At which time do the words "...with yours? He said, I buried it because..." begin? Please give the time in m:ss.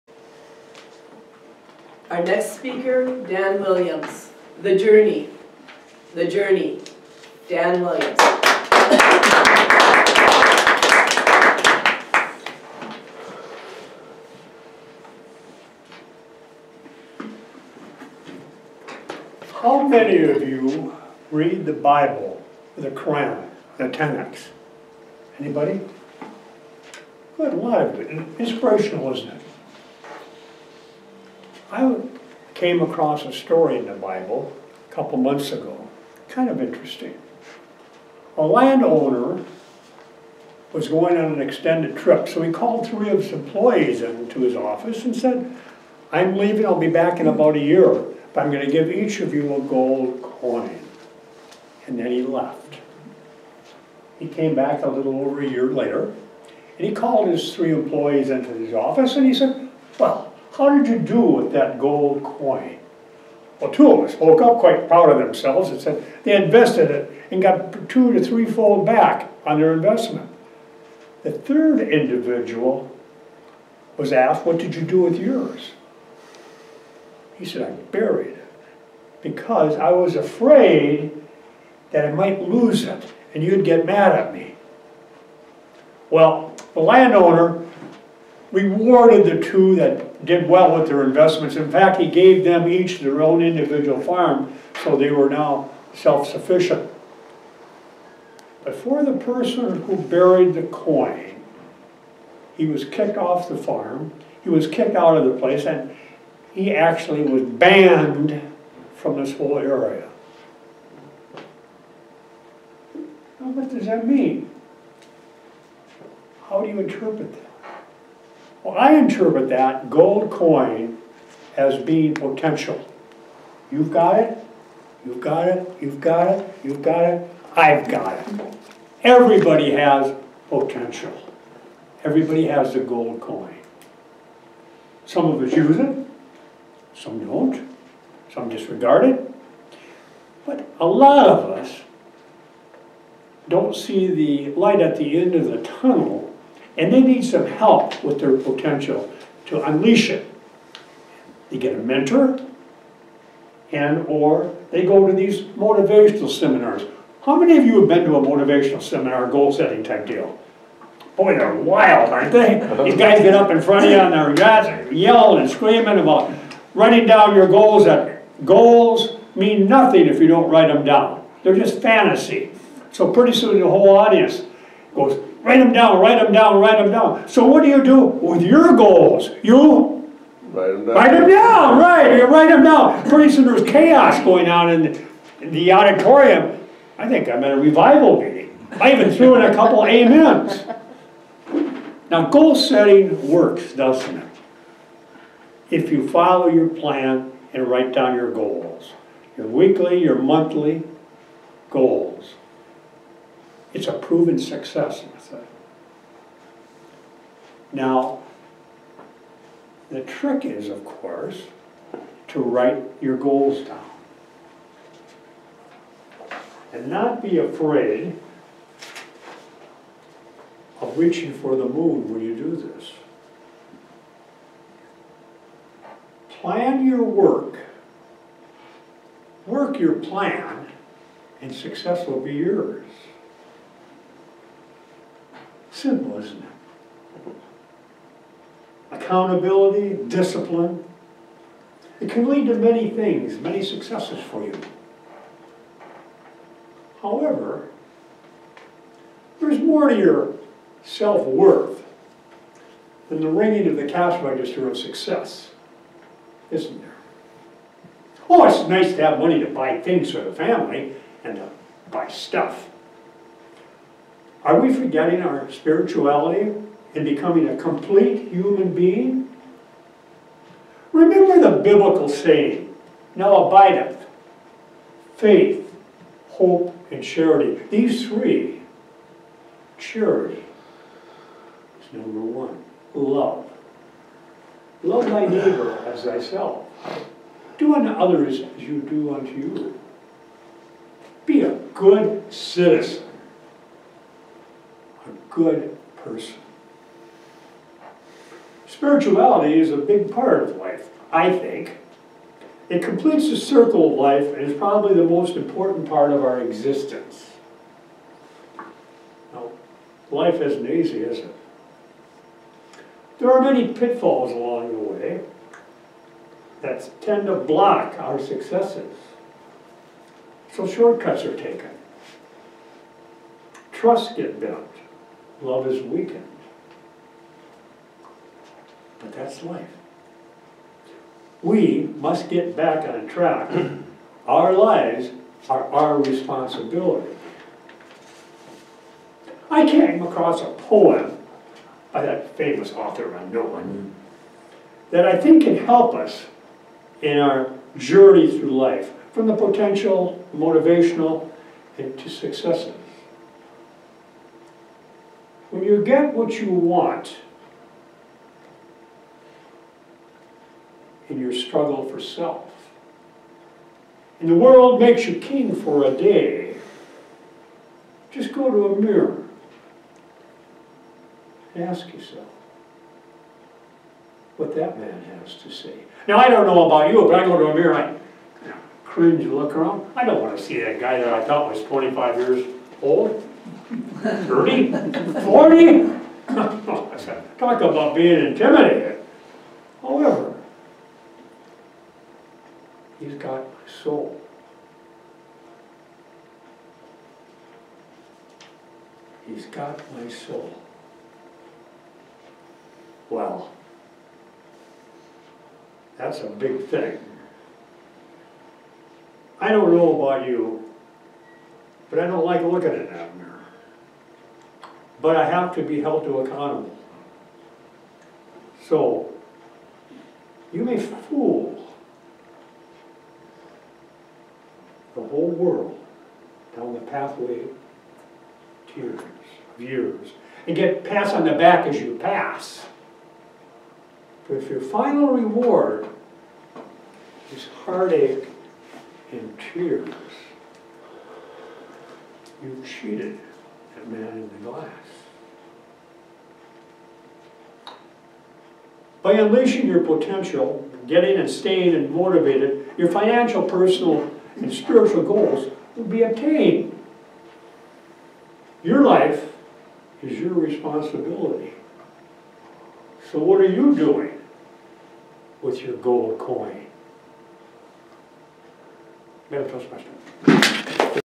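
1:15.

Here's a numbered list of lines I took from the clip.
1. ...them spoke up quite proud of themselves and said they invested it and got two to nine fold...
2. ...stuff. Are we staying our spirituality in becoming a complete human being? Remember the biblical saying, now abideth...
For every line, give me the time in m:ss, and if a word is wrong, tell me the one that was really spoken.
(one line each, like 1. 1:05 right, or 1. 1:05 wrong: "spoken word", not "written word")
1. 1:04 wrong: "three", not "nine"
2. 4:22 wrong: "forgetting", not "staying".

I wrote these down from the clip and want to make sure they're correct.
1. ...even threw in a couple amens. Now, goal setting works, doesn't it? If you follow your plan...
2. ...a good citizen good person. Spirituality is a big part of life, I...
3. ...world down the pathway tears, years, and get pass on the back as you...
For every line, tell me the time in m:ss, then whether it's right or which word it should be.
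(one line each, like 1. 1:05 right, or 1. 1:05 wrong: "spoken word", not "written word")
1. 3:08 right
2. 4:51 right
3. 7:05 right.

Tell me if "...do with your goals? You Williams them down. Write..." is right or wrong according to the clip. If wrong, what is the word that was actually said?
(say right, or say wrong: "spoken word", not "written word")
wrong: "Write", not "Williams".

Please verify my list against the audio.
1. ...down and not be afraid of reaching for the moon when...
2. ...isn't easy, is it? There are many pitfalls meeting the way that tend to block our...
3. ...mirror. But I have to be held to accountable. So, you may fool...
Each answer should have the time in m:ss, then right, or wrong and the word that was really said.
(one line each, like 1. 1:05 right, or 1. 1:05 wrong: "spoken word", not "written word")
1. 3:33 right
2. 5:10 wrong: "along", not "meeting"
3. 6:53 right.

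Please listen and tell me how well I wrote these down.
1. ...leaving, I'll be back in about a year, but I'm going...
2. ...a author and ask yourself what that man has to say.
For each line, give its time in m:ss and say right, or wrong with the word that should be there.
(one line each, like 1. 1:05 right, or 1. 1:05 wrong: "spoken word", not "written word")
1. 0:46 right
2. 6:08 wrong: "mirror", not "author".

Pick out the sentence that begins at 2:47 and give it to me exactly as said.
That goals mean nothing if you don't write them down.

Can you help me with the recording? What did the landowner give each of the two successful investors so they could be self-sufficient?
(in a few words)
their own individual farm.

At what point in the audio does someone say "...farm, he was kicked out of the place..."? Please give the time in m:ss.
1:43.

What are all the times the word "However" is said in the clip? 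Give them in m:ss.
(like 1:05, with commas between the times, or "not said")
4:07, 6:29.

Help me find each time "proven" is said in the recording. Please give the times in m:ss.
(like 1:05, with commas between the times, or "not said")
3:23.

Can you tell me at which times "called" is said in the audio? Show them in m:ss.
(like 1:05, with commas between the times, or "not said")
0:42, 0:56.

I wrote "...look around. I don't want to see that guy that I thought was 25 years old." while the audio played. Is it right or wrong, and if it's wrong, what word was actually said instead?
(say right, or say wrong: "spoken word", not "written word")
right.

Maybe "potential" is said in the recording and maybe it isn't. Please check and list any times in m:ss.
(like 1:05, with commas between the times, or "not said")
2:02, 2:10, 2:28, 5:49, 7:29.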